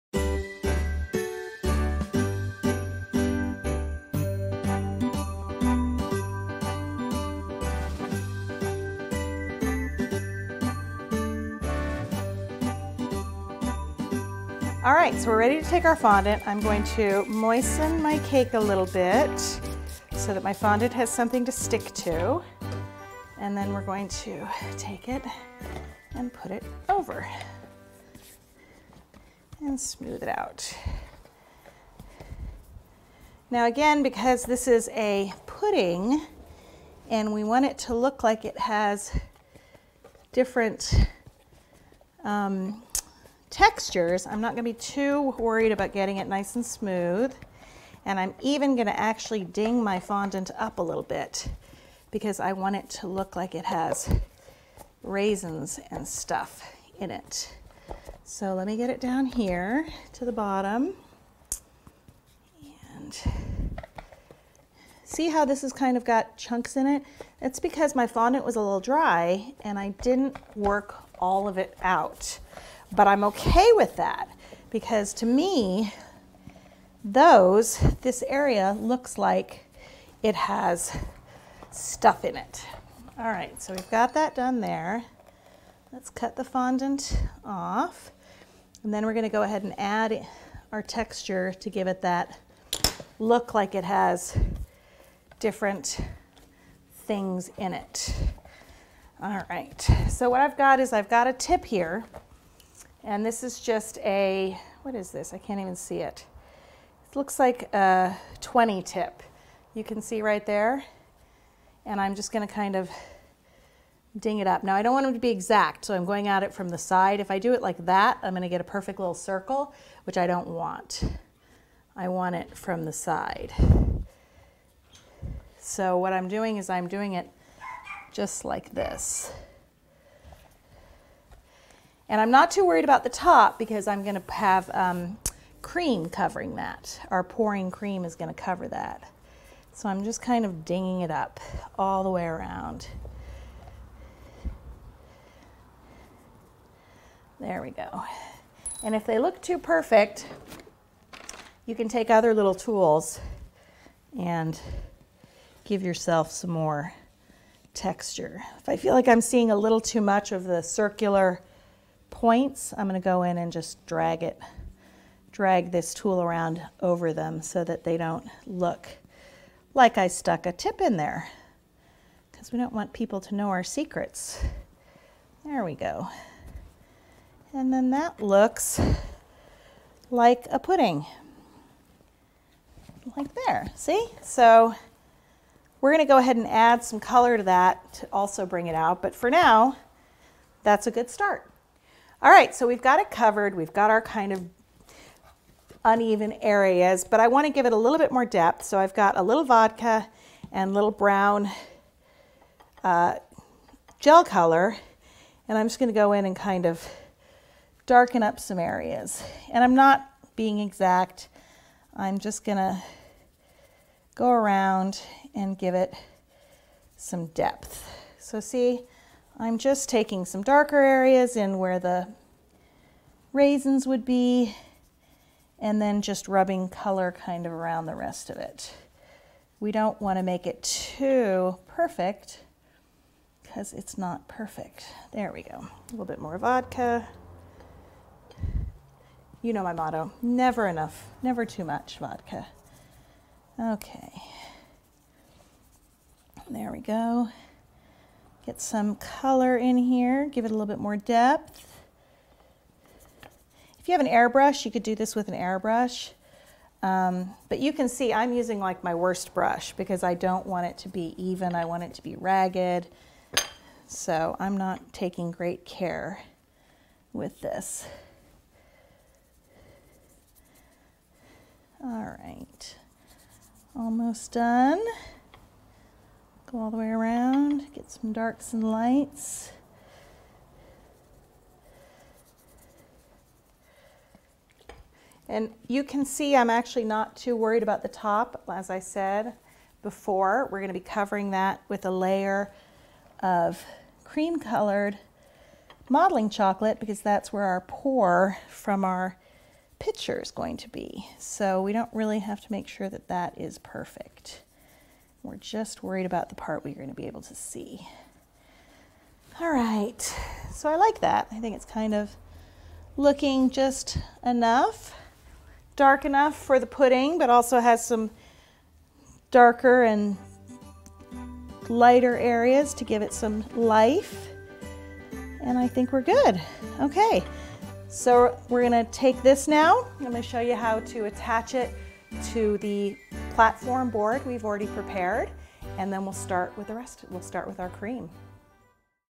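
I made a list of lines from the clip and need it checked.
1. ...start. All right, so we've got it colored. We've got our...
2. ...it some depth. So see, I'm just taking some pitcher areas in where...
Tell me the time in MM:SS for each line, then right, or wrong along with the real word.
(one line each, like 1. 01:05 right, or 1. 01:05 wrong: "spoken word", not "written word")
1. 03:11 wrong: "covered", not "colored"
2. 03:35 wrong: "darker", not "pitcher".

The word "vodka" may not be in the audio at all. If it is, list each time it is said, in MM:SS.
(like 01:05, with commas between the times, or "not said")
03:19, 03:56, 04:01.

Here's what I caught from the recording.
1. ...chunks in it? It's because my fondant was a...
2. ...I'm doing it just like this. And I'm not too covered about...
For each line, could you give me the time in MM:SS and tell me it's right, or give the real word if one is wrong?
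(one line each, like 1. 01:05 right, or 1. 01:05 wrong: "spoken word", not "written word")
1. 01:06 right
2. 02:06 wrong: "worried", not "covered".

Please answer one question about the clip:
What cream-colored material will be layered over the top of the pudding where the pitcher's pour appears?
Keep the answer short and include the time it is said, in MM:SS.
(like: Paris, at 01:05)
Modeling chocolate, at 04:55.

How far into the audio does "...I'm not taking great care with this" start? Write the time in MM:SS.
04:24.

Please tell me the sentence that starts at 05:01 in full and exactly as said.
So we don't really have to make sure that that is perfect.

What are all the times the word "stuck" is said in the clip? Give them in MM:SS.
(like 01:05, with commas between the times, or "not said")
02:50.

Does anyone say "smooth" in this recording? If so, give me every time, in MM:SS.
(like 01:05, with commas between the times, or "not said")
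00:29, 00:46.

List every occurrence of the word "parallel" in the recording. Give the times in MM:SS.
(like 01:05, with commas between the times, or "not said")
not said.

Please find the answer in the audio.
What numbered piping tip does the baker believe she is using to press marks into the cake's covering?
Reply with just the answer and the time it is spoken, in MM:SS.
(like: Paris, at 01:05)
20, at 01:48.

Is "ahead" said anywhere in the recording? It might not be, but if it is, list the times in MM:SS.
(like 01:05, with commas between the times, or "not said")
01:29, 03:06.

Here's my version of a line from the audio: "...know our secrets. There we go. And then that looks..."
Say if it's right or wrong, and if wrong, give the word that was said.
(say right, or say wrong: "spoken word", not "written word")
right.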